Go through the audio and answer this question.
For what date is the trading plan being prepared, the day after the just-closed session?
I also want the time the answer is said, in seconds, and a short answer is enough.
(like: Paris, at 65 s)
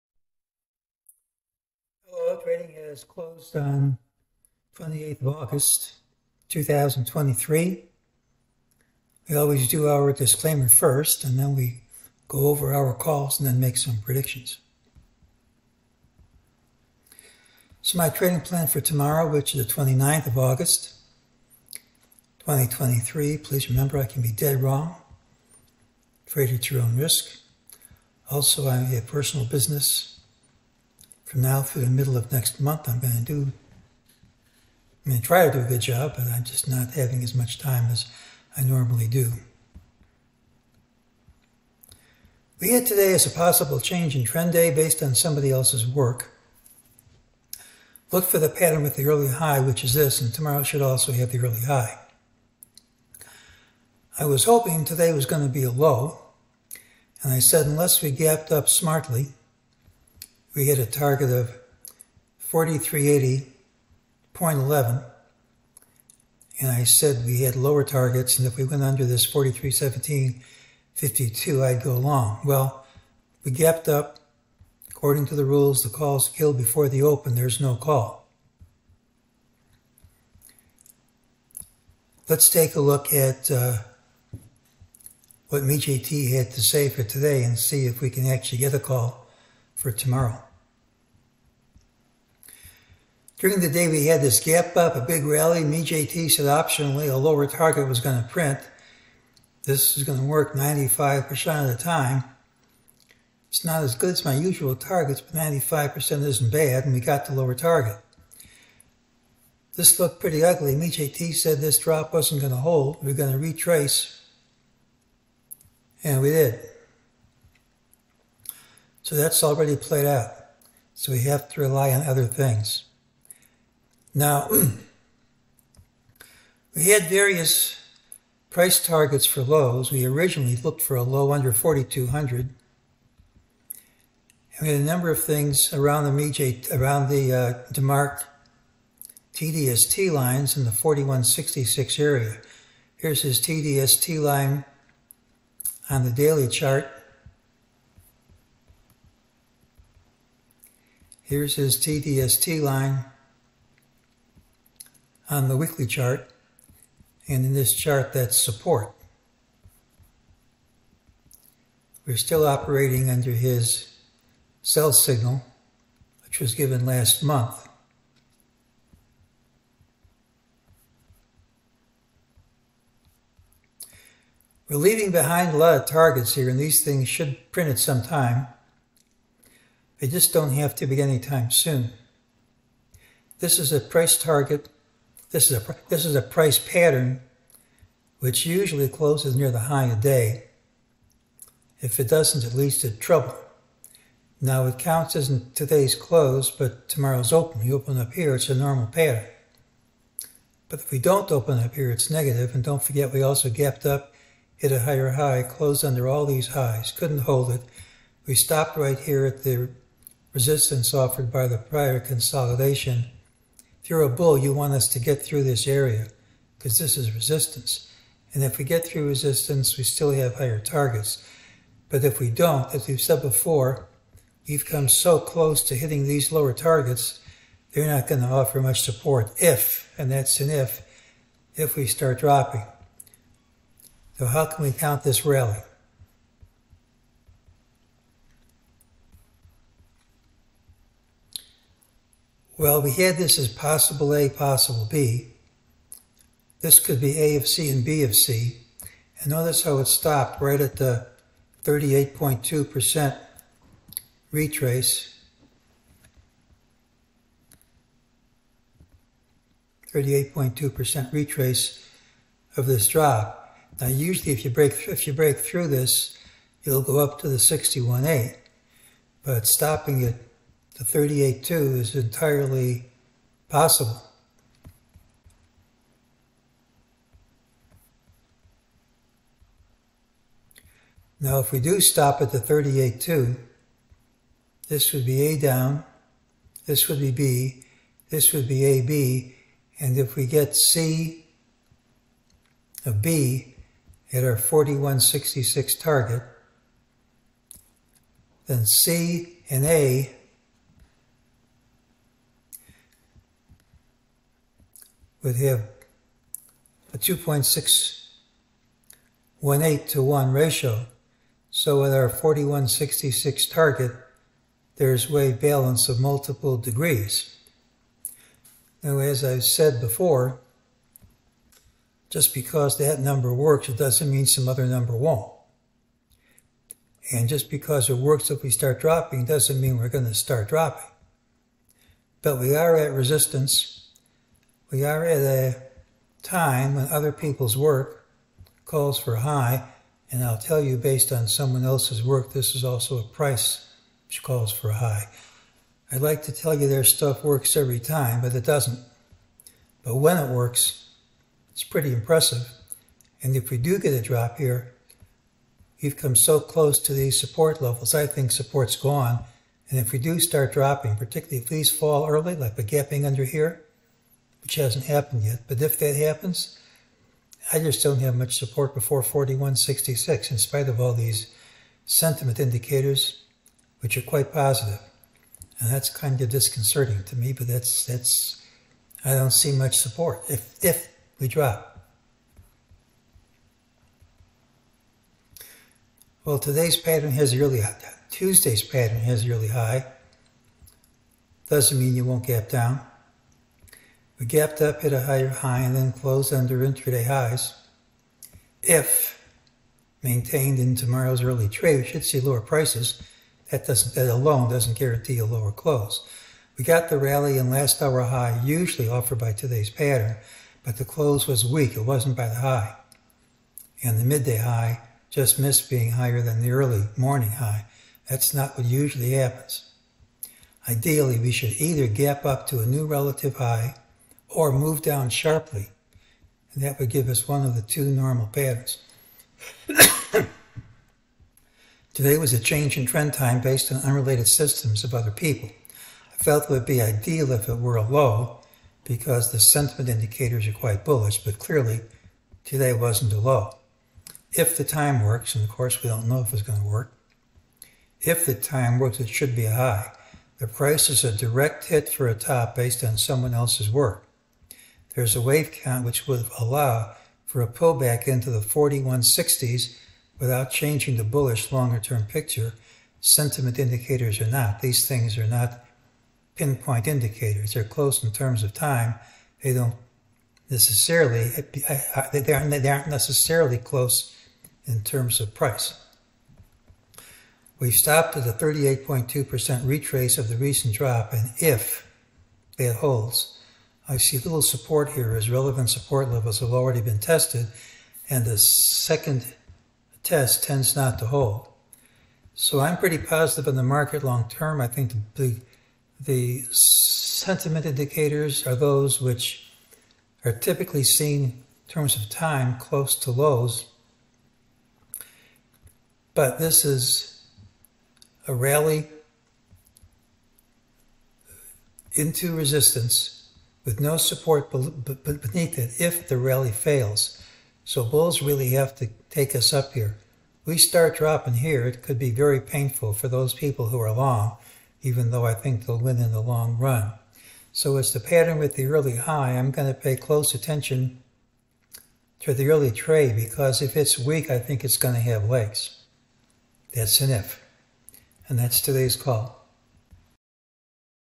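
29th of August, 2023, at 19 s.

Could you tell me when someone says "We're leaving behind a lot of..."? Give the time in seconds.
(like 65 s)
174 s.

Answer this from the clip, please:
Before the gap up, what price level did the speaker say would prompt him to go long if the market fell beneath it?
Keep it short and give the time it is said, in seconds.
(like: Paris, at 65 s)
4317.52, at 69 s.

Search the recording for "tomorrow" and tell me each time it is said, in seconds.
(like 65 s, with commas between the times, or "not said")
18 s, 50 s, 89 s, 196 s, 400 s.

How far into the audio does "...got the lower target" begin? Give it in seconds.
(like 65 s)
106 s.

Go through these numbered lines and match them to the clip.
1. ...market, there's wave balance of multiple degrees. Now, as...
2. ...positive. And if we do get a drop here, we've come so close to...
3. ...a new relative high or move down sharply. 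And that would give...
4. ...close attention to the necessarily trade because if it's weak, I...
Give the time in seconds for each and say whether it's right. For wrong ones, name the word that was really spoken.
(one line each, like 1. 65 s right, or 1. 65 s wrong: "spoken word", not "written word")
1. 313 s wrong: "target", not "market"
2. 351 s wrong: "impressive", not "positive"
3. 422 s right
4. 529 s wrong: "early", not "necessarily".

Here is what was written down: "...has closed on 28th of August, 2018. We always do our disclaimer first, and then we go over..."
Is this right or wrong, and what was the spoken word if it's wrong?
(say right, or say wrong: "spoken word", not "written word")
wrong: "2023", not "2018".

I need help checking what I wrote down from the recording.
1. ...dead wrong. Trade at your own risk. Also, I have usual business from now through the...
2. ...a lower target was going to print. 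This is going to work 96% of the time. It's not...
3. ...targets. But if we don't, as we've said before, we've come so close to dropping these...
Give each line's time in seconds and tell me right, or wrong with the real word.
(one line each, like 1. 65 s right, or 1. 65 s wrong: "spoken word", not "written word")
1. 24 s wrong: "personal", not "usual"
2. 97 s wrong: "95", not "96"
3. 220 s wrong: "hitting", not "dropping".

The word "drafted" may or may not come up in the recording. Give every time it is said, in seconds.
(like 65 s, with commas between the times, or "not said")
not said.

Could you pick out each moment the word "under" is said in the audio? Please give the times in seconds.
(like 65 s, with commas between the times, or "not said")
68 s, 131 s, 163 s, 205 s, 363 s, 396 s.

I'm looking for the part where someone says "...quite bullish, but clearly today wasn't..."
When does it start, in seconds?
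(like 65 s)
440 s.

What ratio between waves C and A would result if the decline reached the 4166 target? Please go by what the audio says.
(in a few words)
2.618 to 1.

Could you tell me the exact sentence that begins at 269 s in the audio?
But stopping at the 38.2 is entirely possible.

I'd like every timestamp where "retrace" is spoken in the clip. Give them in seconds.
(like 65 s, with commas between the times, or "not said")
113 s, 254 s, 261 s, 479 s.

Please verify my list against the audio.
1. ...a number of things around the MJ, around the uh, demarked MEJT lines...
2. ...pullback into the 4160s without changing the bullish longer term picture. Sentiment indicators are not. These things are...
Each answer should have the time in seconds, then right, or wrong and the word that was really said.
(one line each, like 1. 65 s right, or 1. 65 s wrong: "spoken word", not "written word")
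1. 134 s wrong: "TDST", not "MEJT"
2. 457 s right.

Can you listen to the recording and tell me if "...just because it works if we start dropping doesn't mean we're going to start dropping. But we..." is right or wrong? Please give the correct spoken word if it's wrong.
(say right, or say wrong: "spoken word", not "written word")
right.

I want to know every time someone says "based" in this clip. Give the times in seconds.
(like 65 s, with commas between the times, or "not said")
44 s, 340 s, 433 s, 452 s.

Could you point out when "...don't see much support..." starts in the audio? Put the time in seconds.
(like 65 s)
379 s.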